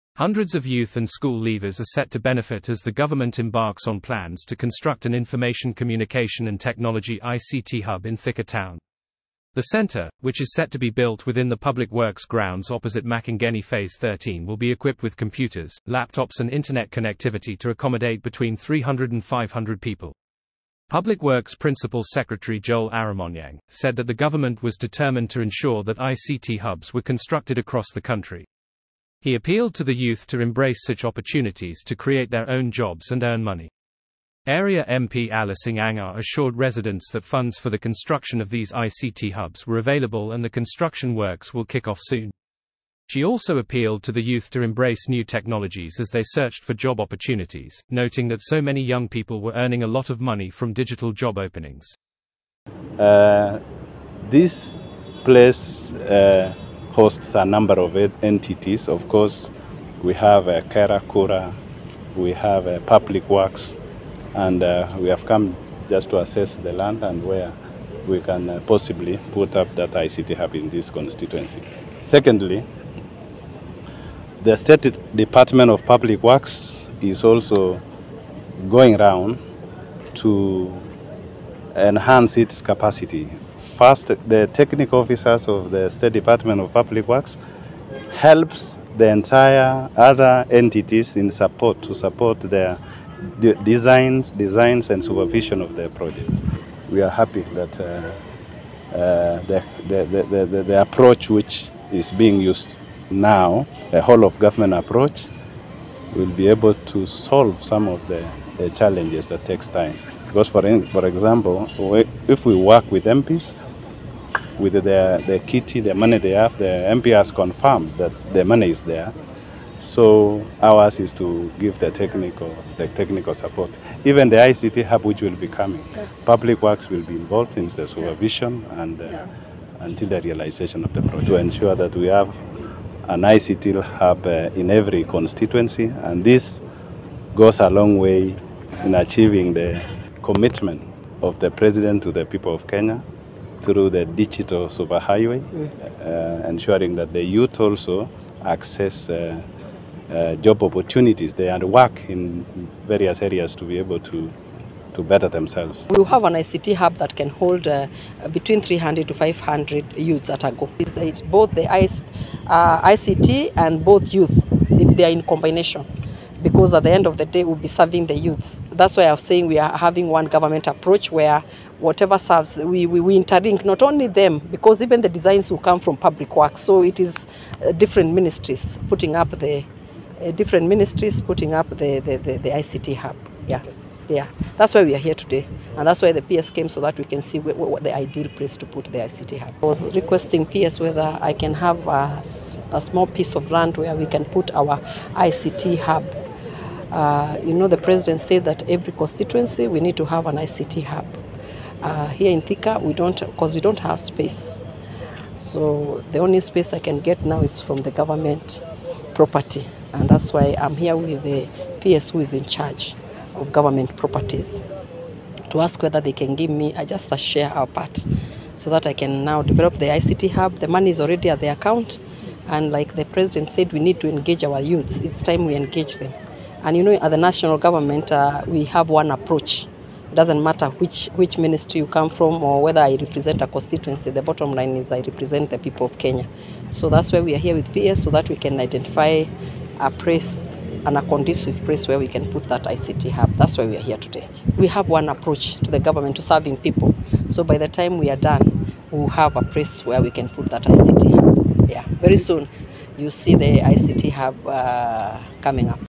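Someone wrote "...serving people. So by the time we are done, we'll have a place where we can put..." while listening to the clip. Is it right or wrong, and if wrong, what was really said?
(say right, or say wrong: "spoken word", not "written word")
right.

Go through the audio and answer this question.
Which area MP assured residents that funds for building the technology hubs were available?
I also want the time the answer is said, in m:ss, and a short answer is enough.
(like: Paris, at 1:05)
Alice Angar, at 0:35.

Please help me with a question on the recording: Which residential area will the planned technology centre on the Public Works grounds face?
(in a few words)
Makongeni Phase 13.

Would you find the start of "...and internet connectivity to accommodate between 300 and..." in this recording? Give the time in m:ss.
0:16.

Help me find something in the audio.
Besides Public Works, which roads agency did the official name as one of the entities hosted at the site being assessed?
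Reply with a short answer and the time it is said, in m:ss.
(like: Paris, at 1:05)
KeRRA, at 1:00.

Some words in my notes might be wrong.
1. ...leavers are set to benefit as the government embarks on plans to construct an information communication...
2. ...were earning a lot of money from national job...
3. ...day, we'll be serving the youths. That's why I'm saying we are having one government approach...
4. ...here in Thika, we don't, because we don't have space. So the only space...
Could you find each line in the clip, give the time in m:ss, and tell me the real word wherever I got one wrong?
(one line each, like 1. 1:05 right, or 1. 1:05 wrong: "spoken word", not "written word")
1. 0:01 right
2. 0:49 wrong: "digital", not "national"
3. 2:47 right
4. 3:22 right.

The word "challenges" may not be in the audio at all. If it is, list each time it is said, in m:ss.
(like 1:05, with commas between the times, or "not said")
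1:48.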